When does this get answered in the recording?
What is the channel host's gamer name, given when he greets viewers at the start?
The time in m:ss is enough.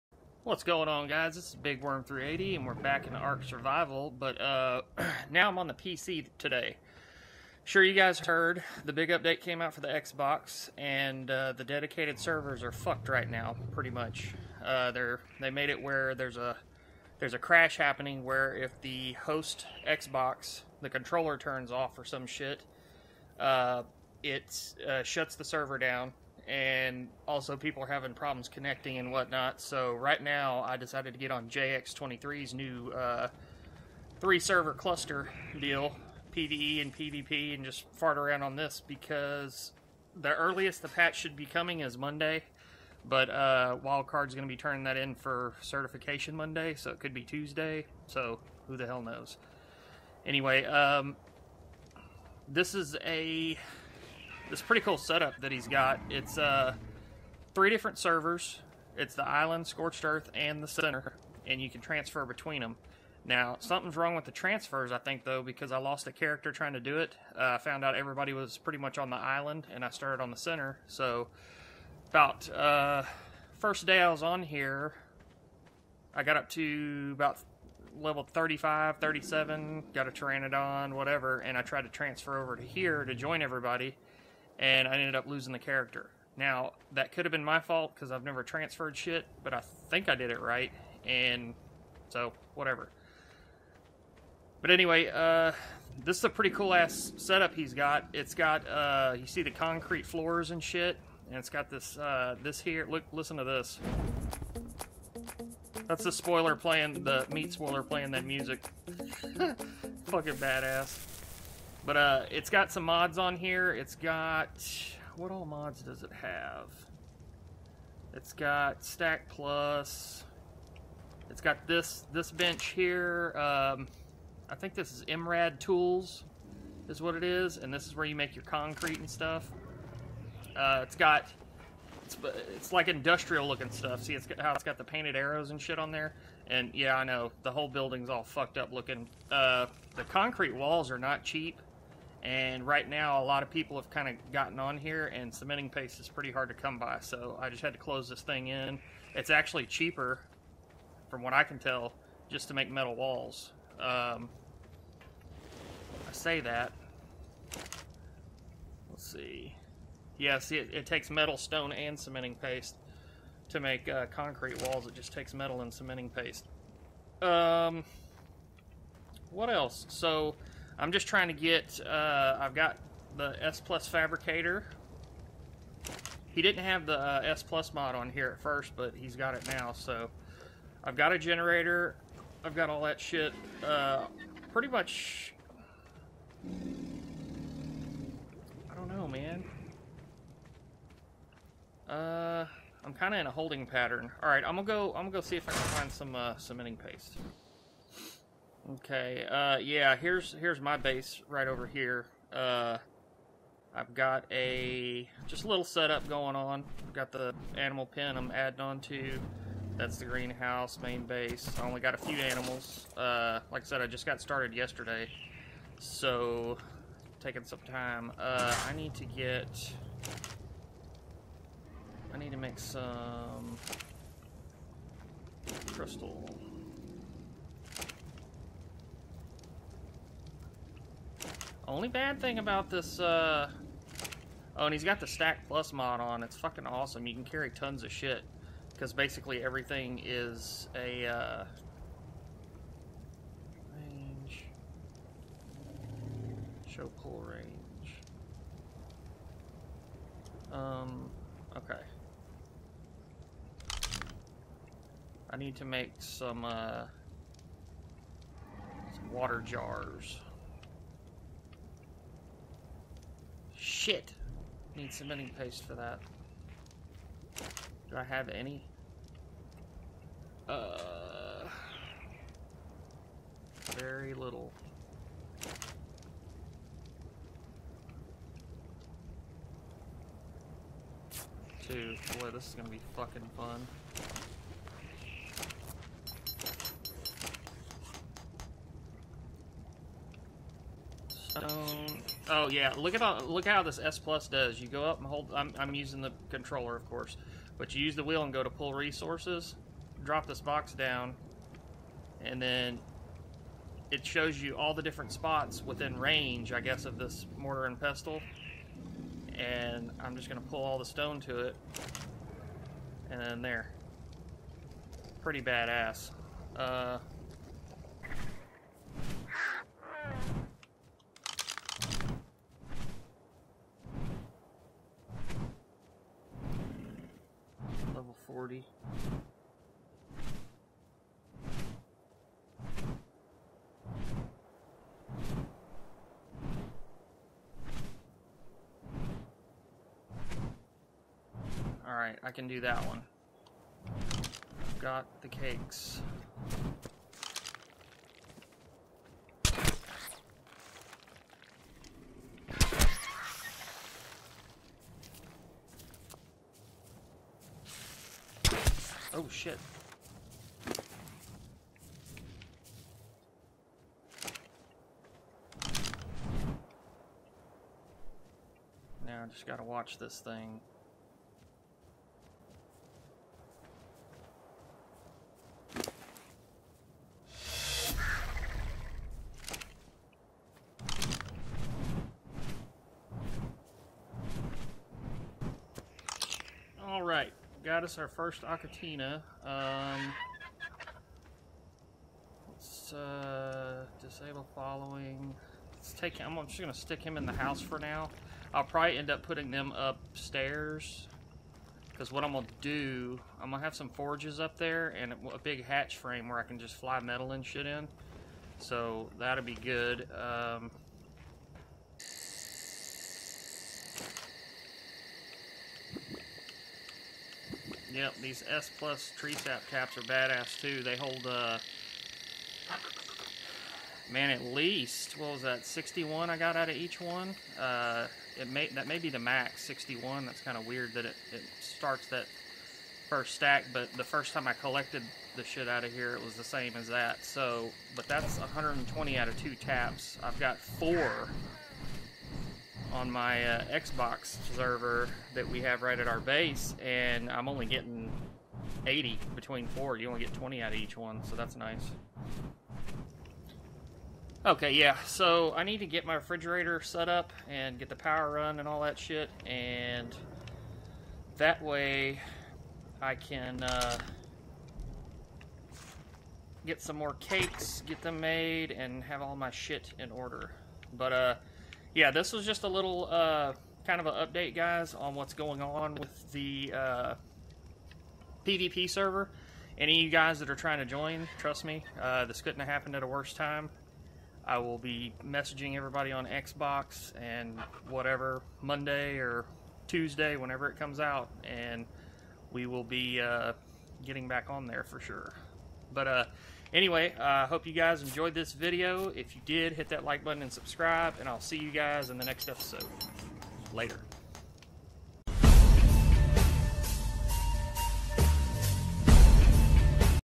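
0:01.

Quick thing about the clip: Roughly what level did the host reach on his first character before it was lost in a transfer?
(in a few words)
35 to 37.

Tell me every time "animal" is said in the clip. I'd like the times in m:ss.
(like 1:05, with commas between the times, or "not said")
3:27, 3:32.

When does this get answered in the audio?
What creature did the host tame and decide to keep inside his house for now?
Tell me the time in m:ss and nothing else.
6:28.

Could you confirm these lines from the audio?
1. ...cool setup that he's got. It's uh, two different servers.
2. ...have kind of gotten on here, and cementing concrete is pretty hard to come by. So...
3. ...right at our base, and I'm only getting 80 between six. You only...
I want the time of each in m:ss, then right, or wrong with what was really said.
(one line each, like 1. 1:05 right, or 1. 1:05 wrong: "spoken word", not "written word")
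1. 0:54 wrong: "three", not "two"
2. 2:23 wrong: "paste", not "concrete"
3. 7:25 wrong: "four", not "six".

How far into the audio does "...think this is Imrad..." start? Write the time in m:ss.
2:04.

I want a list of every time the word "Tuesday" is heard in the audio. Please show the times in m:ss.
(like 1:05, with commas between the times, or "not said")
0:47, 8:09.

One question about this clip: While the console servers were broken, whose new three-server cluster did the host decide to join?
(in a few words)
JX23.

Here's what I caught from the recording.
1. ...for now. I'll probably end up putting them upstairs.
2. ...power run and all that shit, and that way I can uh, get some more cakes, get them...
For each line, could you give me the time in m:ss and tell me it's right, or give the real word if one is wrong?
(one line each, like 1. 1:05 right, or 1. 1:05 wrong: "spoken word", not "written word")
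1. 6:37 right
2. 7:37 right.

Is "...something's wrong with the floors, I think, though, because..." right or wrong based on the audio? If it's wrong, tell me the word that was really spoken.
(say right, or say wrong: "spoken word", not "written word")
wrong: "transfers", not "floors".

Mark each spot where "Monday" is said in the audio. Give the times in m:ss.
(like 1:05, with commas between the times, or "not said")
0:41, 0:46, 8:08.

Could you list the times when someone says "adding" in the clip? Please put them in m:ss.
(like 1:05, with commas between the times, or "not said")
3:28.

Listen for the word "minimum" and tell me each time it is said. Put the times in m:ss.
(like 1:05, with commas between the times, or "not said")
not said.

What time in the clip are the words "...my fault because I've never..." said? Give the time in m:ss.
1:27.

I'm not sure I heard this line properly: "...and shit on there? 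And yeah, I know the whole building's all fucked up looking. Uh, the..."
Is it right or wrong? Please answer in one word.
right.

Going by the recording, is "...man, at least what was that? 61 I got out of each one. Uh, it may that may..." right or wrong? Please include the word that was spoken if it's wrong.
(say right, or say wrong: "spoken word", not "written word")
right.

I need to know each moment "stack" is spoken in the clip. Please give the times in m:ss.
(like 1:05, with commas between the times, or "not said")
1:58, 3:55, 7:13.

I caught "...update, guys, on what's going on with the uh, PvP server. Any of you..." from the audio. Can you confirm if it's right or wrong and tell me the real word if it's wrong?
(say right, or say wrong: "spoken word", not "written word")
right.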